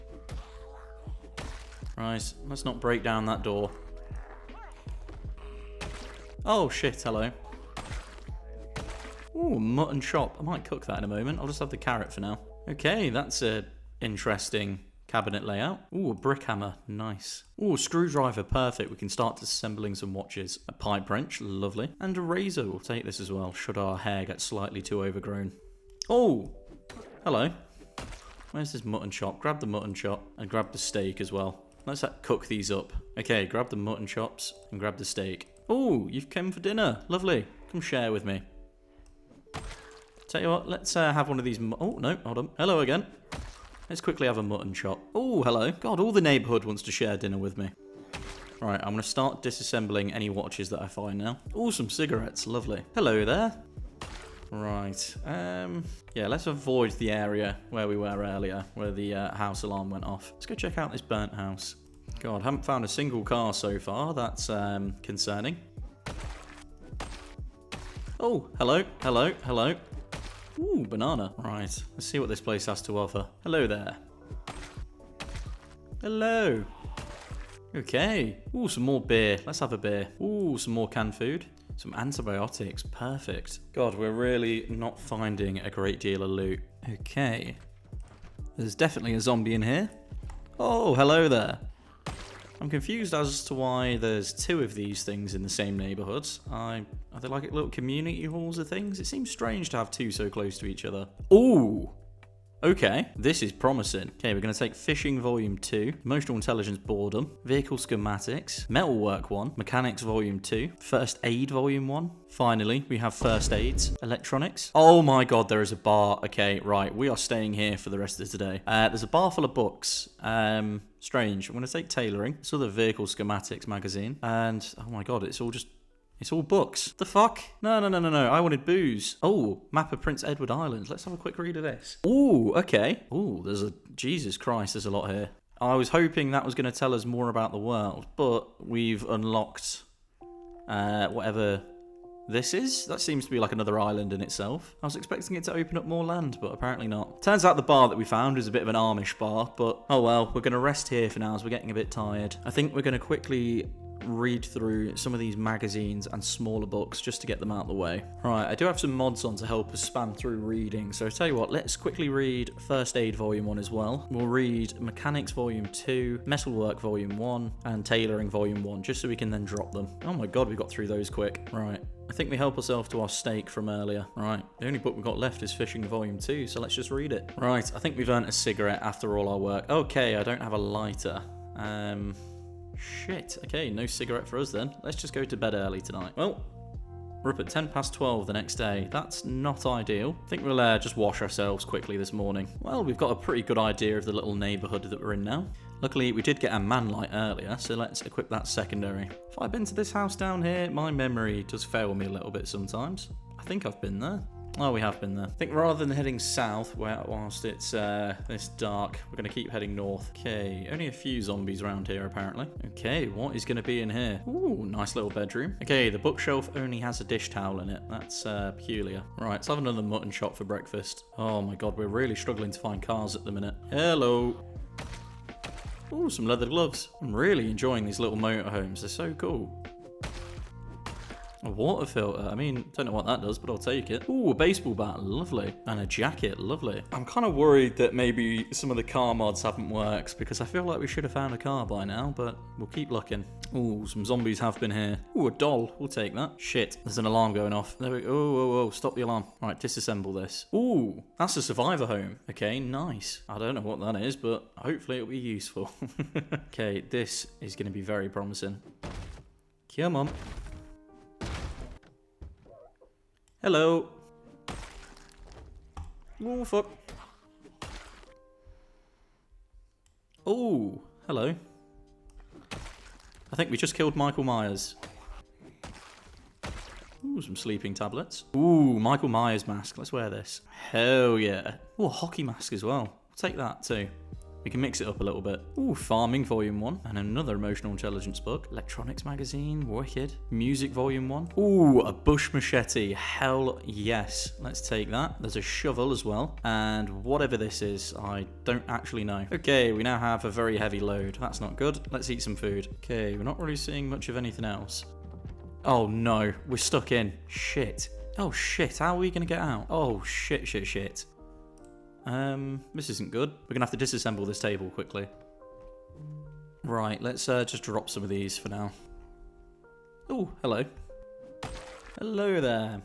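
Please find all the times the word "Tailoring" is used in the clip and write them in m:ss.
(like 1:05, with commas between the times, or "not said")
2:01, 2:47.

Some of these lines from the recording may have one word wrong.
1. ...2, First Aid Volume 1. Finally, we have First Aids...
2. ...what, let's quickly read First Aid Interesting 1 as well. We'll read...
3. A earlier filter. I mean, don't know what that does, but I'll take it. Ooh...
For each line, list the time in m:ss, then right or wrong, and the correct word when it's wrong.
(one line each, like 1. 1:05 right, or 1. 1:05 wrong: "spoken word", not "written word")
1. 1:50 right
2. 2:41 wrong: "Volume", not "Interesting"
3. 3:51 wrong: "water", not "earlier".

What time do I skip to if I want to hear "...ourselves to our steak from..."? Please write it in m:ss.
2:52.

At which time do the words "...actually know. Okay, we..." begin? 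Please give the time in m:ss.
4:58.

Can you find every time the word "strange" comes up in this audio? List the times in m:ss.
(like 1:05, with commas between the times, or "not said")
1:39, 2:00.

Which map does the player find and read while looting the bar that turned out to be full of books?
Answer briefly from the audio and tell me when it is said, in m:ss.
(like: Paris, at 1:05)
Prince Edward Island, at 2:10.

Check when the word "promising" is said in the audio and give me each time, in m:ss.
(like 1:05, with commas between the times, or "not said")
1:43, 4:18.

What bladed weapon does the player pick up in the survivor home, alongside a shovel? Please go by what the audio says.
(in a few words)
Bush machete.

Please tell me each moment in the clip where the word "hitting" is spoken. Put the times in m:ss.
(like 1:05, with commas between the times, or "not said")
not said.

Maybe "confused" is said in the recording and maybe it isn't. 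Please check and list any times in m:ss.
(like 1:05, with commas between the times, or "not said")
1:32.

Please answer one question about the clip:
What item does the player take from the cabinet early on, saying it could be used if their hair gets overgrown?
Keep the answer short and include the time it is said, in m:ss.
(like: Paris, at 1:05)
A razor, at 0:22.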